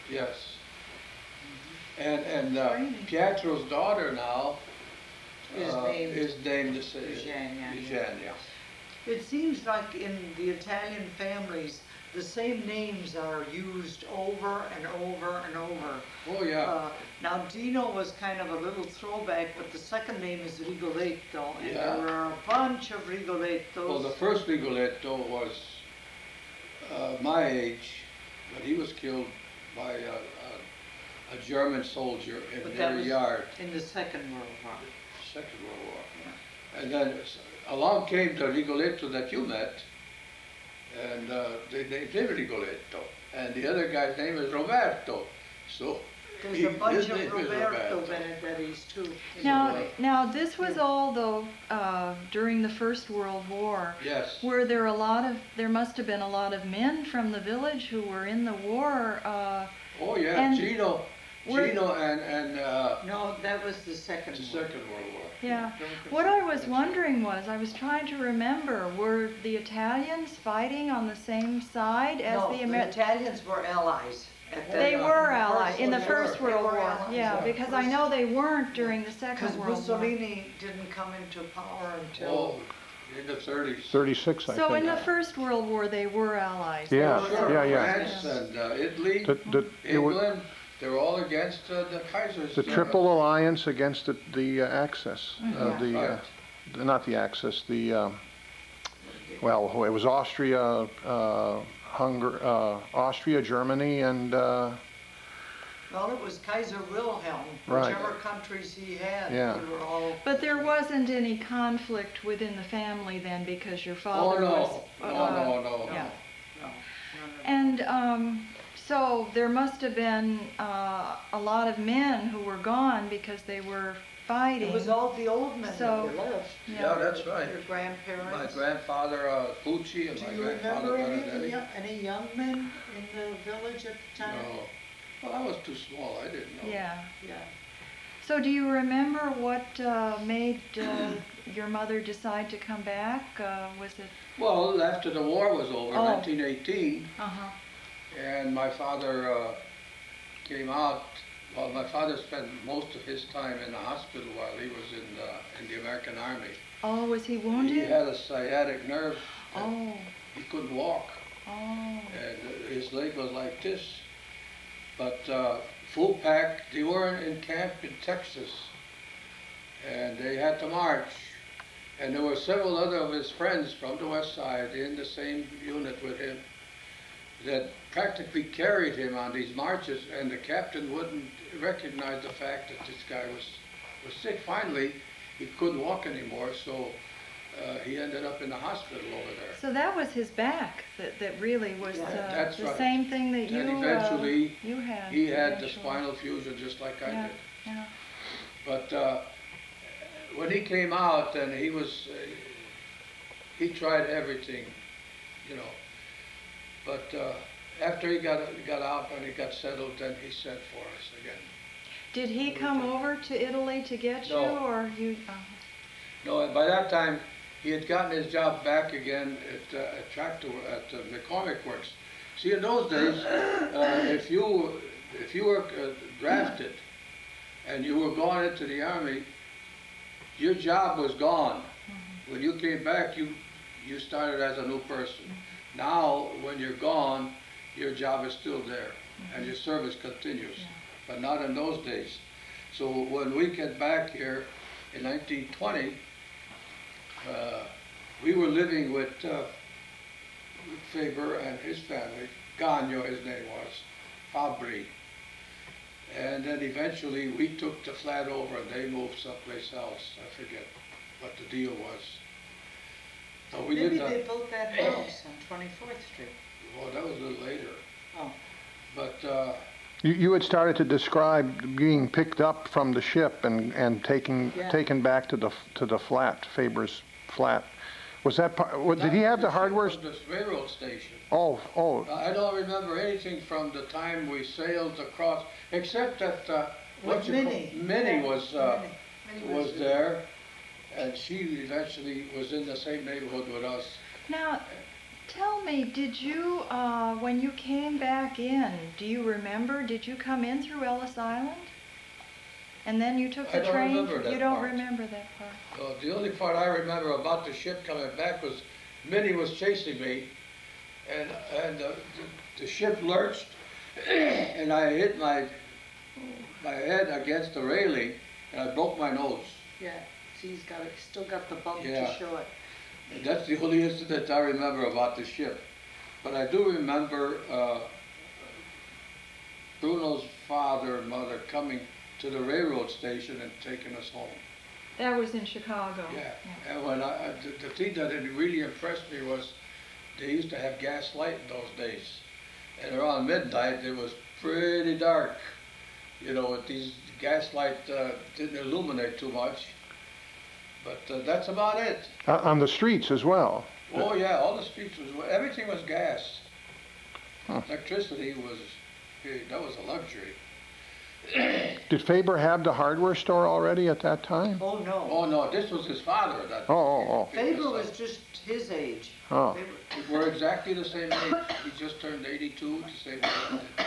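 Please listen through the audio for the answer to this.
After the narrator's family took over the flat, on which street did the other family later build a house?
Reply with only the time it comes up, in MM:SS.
04:25.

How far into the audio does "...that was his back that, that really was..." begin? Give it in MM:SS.
03:09.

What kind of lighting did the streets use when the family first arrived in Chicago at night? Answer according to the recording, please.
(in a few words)
Gas light.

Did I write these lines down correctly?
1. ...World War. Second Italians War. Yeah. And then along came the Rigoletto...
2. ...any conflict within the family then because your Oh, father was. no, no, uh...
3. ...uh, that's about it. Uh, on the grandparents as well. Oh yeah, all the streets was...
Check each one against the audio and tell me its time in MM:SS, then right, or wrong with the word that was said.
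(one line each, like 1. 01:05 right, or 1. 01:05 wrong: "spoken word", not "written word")
1. 00:34 wrong: "World", not "Italians"
2. 01:51 right
3. 05:51 wrong: "streets", not "grandparents".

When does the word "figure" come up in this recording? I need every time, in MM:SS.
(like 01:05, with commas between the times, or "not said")
not said.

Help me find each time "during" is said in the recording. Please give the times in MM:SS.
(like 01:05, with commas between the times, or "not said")
00:52, 01:18.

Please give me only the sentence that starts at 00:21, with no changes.
there are a bunch of Rigolettos.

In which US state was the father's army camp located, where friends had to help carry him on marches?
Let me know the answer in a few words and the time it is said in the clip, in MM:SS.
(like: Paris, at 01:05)
Texas, at 02:48.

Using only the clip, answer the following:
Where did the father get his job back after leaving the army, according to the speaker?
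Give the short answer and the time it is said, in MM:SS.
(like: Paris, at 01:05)
McCormick Works, at 03:41.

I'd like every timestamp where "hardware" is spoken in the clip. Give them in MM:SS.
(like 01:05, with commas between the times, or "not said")
04:39, 06:02.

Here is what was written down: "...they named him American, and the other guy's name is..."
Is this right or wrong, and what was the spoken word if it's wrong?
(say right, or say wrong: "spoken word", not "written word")
wrong: "Rigoletto", not "American".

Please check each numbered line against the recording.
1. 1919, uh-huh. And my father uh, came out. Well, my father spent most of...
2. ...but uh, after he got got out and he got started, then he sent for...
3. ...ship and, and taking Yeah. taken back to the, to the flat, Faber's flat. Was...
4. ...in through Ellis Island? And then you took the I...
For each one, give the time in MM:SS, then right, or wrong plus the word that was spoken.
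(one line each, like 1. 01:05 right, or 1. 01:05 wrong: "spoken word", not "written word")
1. 02:26 wrong: "1918", not "1919"
2. 03:26 wrong: "settled", not "started"
3. 04:33 right
4. 05:00 right.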